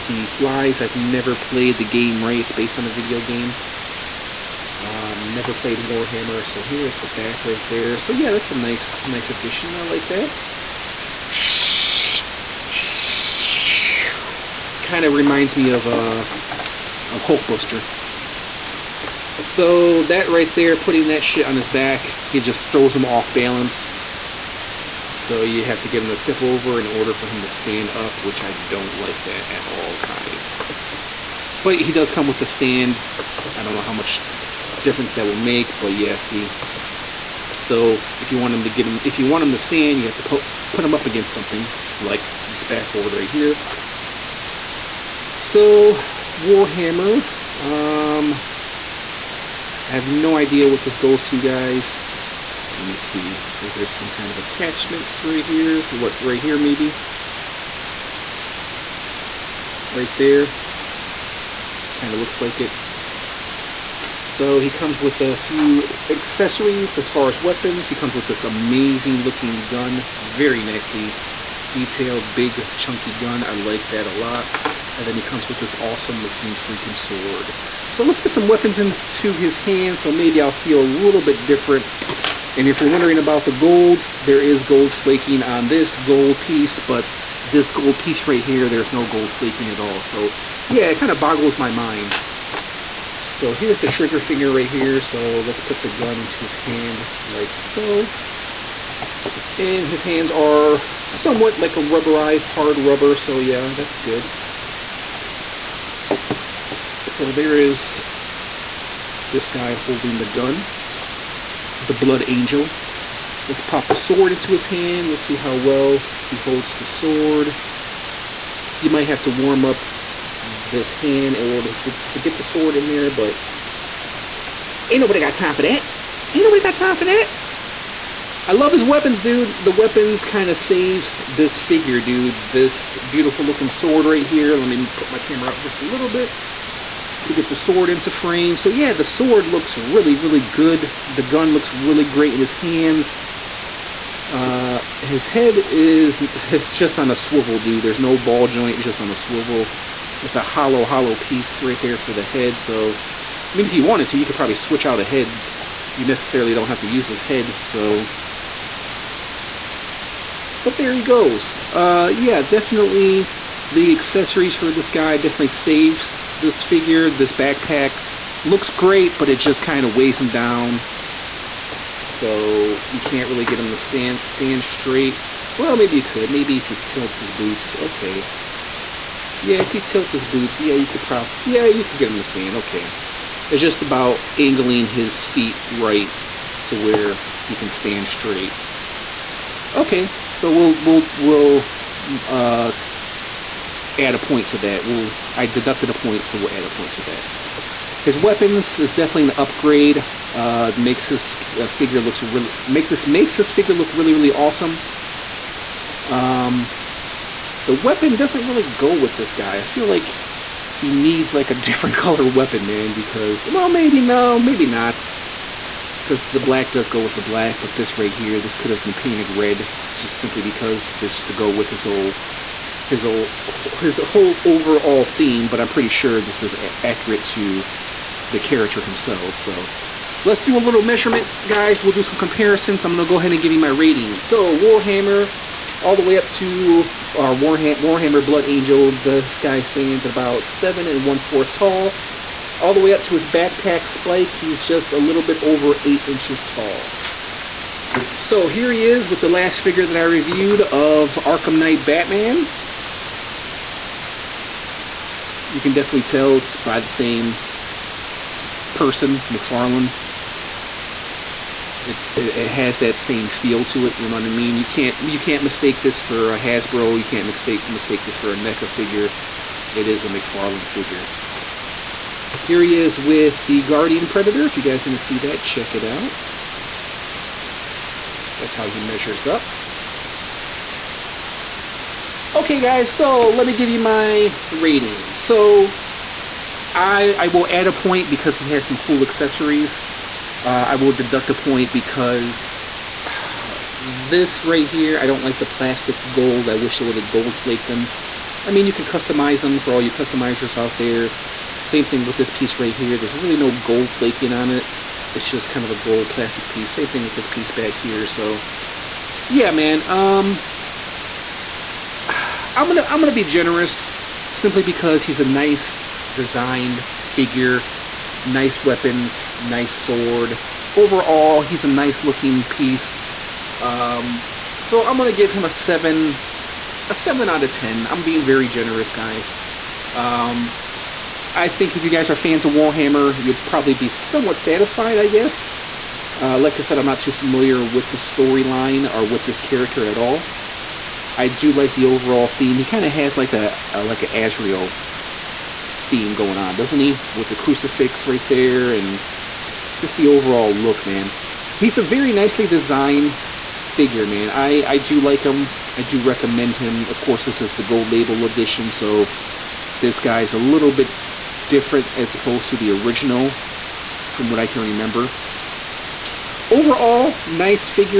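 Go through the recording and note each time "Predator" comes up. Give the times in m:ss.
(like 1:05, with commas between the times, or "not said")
4:34.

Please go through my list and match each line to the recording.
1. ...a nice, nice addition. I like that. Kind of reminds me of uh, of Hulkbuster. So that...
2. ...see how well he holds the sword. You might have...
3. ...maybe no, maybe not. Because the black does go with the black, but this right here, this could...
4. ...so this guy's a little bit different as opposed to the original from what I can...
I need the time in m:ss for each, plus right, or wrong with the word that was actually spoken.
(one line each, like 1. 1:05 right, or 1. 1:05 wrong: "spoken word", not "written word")
1. 0:08 right
2. 1:55 right
3. 3:33 right
4. 5:58 right.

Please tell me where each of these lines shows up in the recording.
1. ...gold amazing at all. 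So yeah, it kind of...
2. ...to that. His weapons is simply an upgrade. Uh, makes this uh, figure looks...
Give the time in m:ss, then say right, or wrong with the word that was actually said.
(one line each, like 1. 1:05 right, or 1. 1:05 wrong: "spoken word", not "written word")
1. 1:29 wrong: "flaking", not "amazing"
2. 3:16 wrong: "definitely", not "simply".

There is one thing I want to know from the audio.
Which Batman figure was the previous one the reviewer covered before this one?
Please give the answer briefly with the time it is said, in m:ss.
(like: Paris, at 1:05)
Arkham Knight Batman, at 4:11.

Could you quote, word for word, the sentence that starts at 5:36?
Uh, like I said, I'm not too familiar with the storyline or with this character at all.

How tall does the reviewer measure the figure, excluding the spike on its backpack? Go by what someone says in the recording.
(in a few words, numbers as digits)
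7 1/4 inches.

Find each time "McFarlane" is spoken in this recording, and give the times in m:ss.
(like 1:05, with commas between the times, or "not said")
4:19, 4:30.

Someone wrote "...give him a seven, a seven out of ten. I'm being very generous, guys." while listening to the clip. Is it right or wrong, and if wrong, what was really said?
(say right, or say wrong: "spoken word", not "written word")
right.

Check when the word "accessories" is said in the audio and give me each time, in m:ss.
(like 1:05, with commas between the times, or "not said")
1:06, 2:43, 4:49.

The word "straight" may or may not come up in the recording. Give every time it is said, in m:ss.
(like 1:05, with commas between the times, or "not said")
2:54, 3:08.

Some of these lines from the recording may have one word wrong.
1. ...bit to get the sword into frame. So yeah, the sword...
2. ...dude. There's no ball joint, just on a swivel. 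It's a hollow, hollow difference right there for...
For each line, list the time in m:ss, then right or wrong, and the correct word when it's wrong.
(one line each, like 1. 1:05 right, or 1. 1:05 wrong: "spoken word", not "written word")
1. 2:16 right
2. 2:27 wrong: "piece", not "difference".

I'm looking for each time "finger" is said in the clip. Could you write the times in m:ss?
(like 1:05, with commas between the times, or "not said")
1:34.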